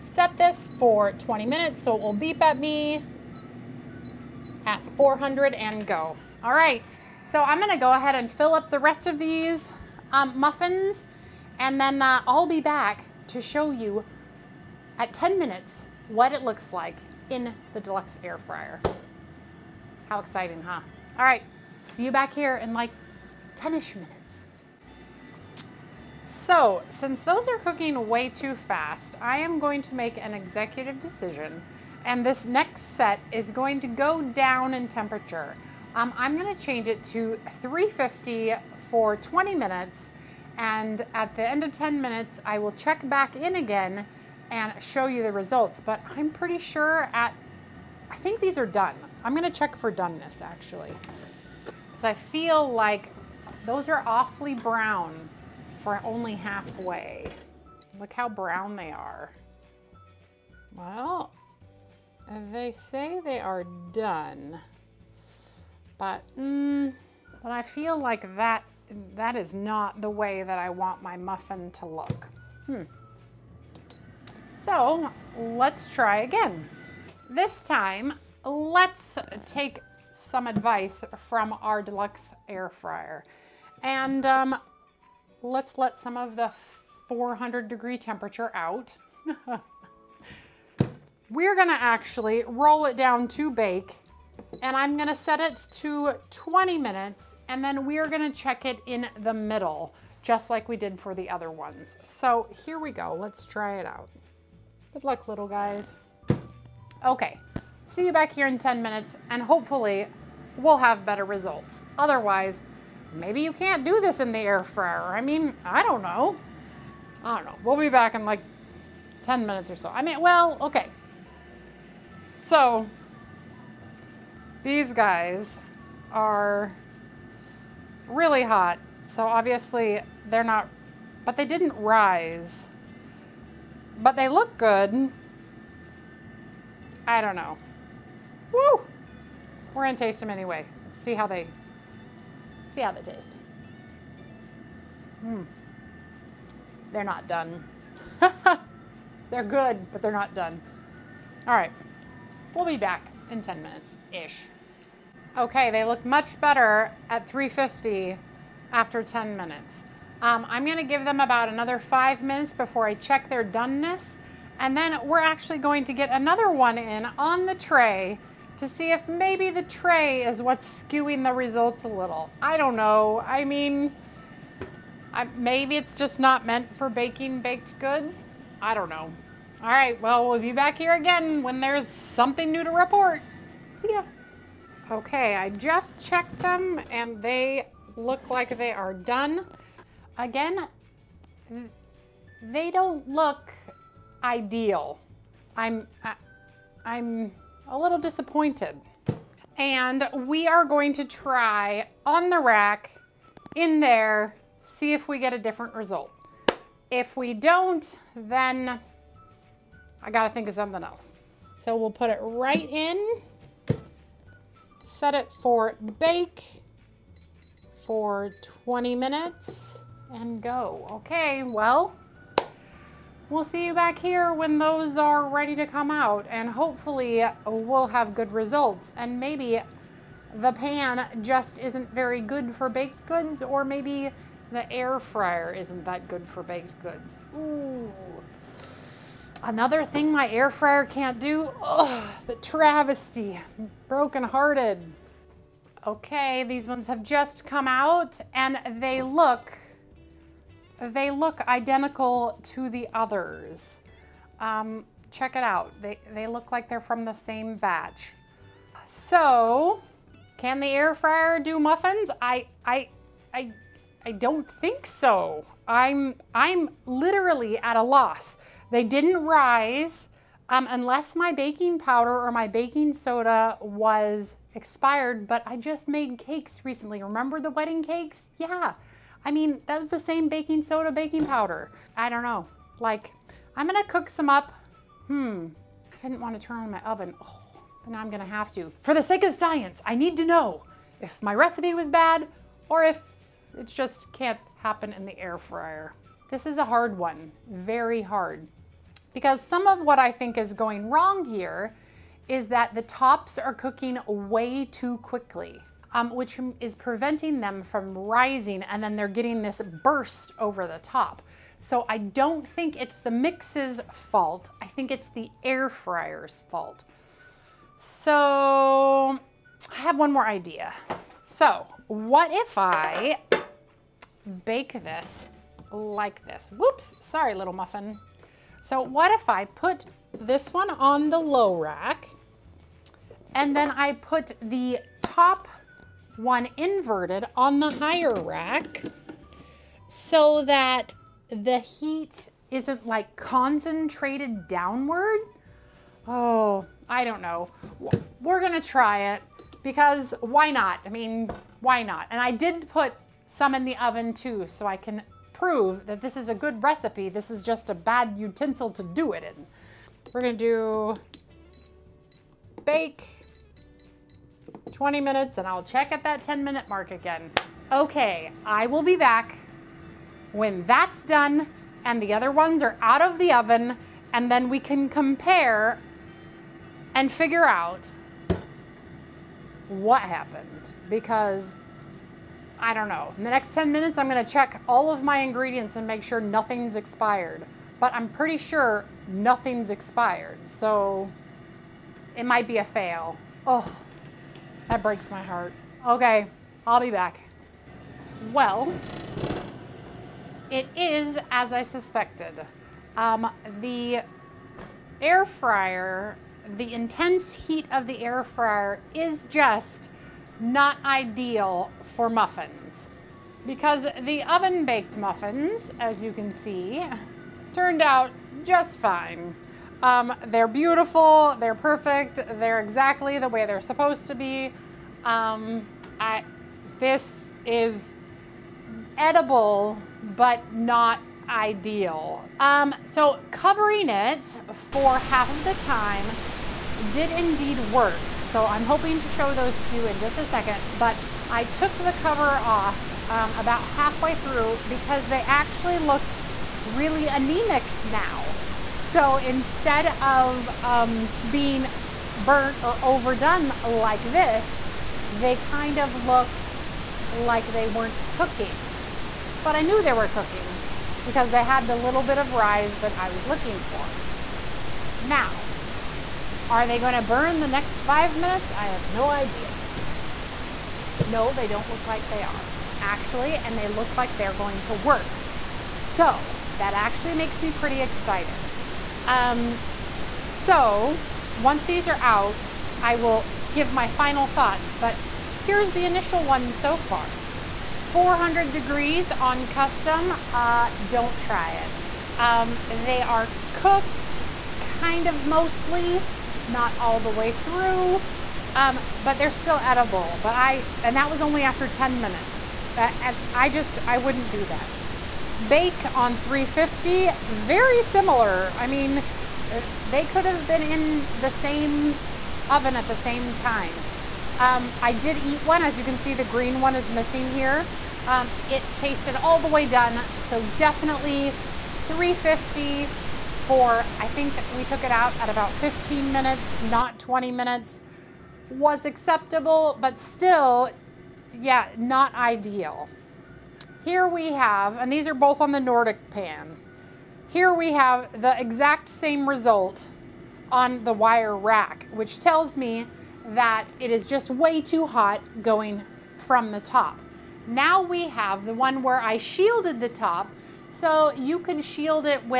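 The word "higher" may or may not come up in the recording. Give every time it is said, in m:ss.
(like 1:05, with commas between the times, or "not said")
5:37.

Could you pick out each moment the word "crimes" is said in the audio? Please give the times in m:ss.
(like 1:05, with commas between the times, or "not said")
not said.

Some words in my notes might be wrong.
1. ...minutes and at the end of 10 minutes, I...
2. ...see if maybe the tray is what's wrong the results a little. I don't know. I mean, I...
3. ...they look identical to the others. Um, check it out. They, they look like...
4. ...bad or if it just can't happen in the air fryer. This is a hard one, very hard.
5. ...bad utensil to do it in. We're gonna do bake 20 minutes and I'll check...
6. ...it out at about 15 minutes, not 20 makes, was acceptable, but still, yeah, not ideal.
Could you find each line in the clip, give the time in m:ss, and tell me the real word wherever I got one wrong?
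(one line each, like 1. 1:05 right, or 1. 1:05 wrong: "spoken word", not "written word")
1. 0:39 right
2. 2:48 wrong: "skewing", not "wrong"
3. 4:10 right
4. 4:51 right
5. 5:57 right
6. 8:44 wrong: "minutes", not "makes".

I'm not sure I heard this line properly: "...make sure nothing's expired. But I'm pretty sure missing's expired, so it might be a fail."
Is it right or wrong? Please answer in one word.
wrong.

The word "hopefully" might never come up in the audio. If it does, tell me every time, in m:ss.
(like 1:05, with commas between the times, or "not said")
1:49, 3:46.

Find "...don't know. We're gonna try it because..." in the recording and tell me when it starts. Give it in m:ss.
5:47.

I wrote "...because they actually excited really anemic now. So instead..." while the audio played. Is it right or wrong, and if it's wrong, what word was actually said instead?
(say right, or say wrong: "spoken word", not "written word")
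wrong: "looked", not "excited".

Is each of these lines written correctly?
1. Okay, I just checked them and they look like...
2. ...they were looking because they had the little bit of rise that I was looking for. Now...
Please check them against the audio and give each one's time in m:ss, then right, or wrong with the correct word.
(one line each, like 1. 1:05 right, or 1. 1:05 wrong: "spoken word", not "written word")
1. 3:04 right
2. 7:39 wrong: "cooking", not "looking".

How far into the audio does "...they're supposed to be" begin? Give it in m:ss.
7:03.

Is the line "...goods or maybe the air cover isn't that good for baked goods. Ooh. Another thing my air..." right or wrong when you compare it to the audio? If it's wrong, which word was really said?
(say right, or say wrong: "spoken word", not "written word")
wrong: "fryer", not "cover".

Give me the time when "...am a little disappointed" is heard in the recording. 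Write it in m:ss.
3:16.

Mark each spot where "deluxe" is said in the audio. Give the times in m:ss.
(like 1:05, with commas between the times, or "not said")
0:17, 1:21.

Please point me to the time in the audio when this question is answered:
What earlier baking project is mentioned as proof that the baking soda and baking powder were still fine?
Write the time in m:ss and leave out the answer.
4:37.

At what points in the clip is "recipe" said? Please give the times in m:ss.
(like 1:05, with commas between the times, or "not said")
4:51, 5:56.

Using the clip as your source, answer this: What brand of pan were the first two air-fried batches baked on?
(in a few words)
Nordic.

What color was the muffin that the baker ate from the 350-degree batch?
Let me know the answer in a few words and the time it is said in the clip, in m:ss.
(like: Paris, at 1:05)
green, at 8:36.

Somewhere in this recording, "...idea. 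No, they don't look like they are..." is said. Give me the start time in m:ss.
7:49.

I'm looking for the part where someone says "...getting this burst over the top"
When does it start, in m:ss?
5:09.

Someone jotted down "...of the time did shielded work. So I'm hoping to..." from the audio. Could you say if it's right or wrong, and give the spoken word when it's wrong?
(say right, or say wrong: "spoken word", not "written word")
wrong: "indeed", not "shielded".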